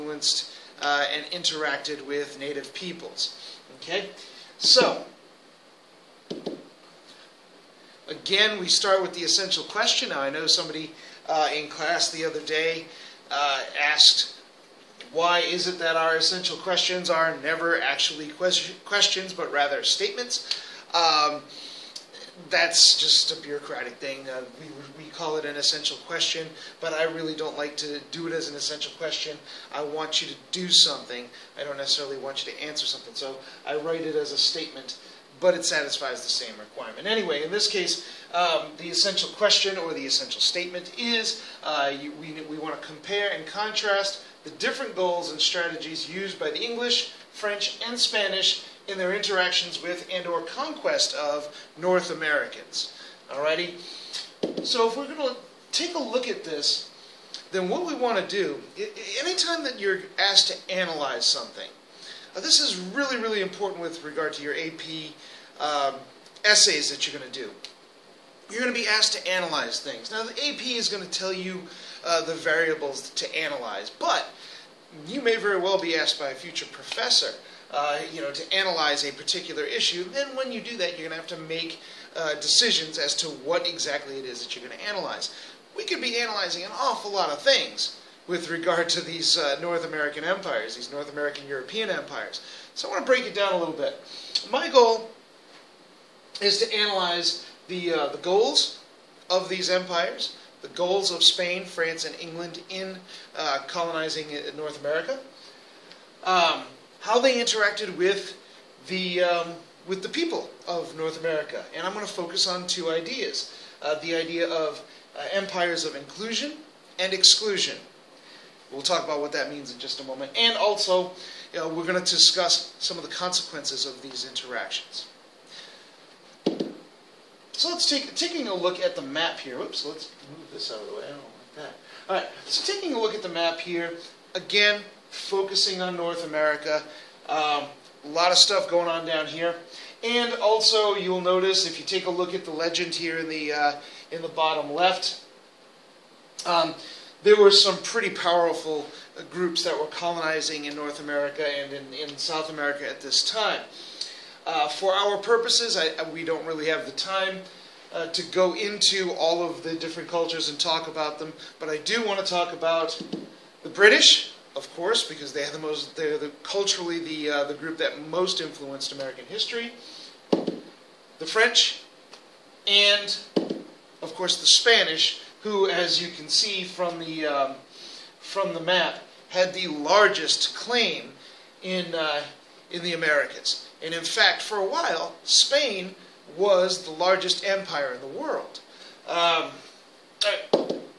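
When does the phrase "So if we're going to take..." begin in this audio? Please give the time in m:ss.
0:54.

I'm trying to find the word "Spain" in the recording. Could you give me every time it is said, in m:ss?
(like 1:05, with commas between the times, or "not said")
1:41, 3:05.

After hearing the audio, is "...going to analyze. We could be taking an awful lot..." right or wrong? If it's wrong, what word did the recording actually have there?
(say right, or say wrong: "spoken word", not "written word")
wrong: "analyzing", not "taking".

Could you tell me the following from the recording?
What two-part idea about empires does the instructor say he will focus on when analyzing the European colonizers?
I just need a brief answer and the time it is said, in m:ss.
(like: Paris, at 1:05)
Inclusion and exclusion, at 1:55.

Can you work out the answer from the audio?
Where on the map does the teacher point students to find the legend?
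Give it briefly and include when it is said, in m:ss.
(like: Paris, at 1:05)
Bottom left, at 2:24.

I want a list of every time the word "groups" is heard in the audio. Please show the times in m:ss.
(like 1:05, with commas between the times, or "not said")
2:29, 2:47.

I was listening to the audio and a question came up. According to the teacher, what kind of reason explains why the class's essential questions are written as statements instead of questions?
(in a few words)
Bureaucratic.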